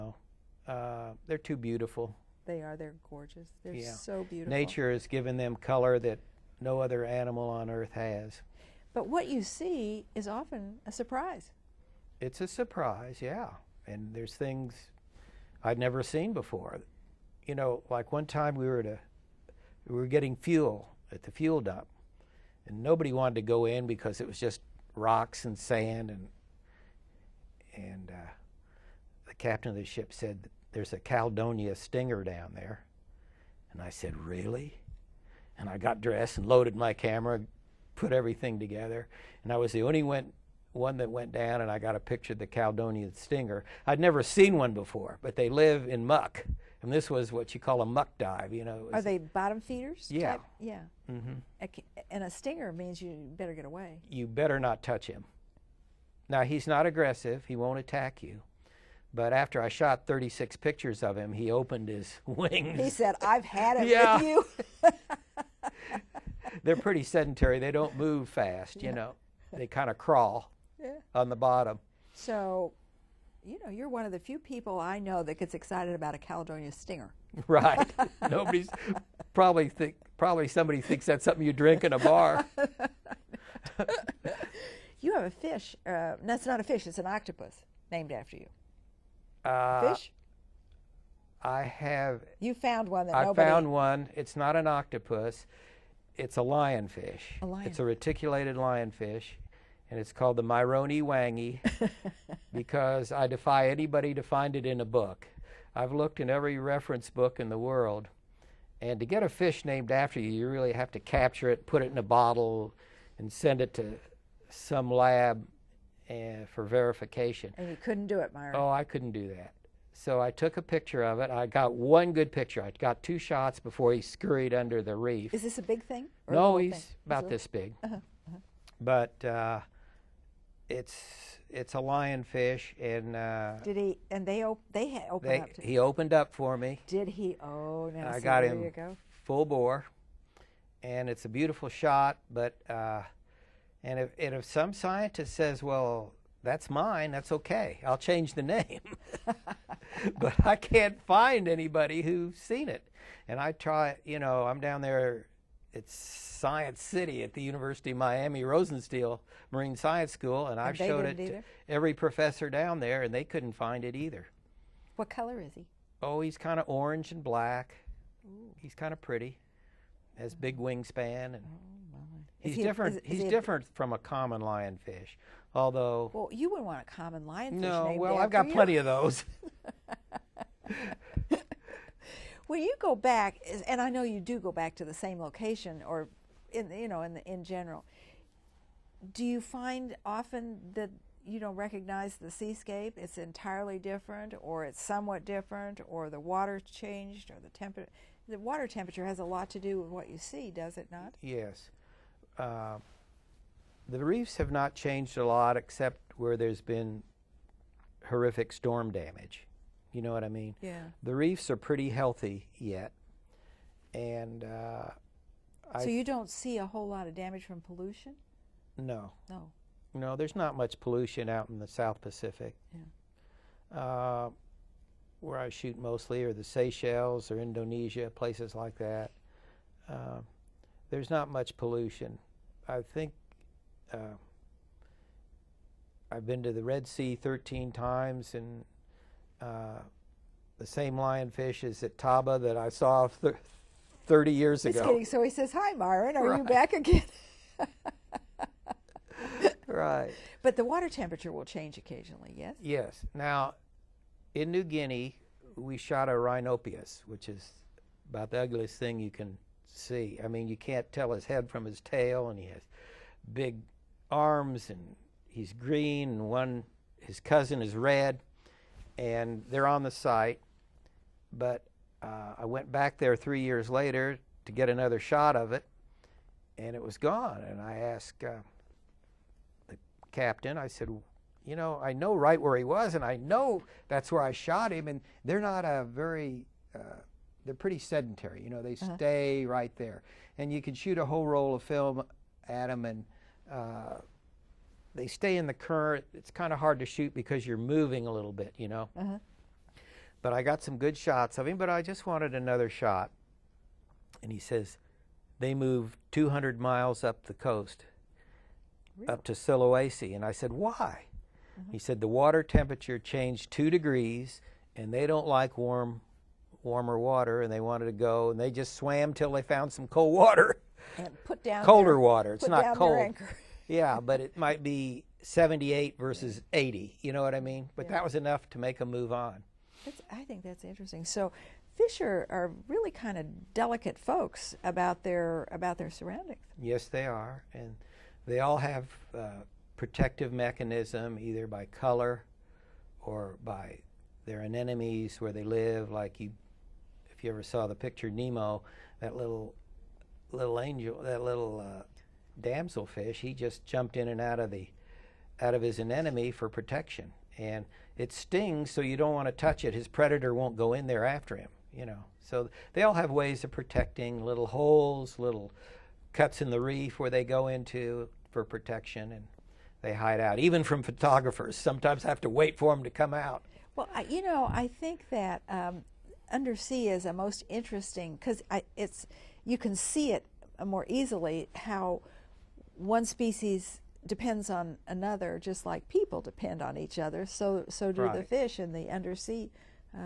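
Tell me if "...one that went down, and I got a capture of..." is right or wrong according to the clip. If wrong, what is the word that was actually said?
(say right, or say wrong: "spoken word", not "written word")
wrong: "picture", not "capture".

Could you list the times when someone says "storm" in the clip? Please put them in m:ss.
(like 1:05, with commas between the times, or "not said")
3:28.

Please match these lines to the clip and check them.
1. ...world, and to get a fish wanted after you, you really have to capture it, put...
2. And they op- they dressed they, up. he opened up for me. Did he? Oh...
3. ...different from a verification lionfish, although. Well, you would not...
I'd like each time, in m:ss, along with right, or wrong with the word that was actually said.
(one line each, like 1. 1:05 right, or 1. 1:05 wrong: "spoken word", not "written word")
1. 1:47 wrong: "named", not "wanted"
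2. 2:14 wrong: "opened", not "dressed"
3. 2:53 wrong: "common", not "verification".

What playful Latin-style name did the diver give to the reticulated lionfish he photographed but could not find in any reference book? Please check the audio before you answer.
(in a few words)
Myroni wangi.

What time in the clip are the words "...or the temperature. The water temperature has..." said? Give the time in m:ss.
3:17.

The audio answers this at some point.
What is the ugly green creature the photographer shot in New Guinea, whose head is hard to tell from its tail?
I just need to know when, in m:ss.
4:16.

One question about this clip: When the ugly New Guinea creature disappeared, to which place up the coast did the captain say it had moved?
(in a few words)
Sulawesi.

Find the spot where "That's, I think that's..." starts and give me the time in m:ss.
5:29.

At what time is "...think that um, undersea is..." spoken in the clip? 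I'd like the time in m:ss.
6:14.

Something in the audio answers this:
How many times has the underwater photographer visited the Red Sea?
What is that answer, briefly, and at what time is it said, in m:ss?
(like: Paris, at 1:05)
13, at 3:57.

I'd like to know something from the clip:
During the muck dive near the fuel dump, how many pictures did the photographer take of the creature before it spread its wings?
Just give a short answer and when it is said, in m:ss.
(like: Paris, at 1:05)
36, at 1:00.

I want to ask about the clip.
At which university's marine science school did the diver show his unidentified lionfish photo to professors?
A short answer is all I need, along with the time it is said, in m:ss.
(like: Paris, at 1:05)
University of Miami, at 2:37.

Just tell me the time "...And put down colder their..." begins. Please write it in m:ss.
5:20.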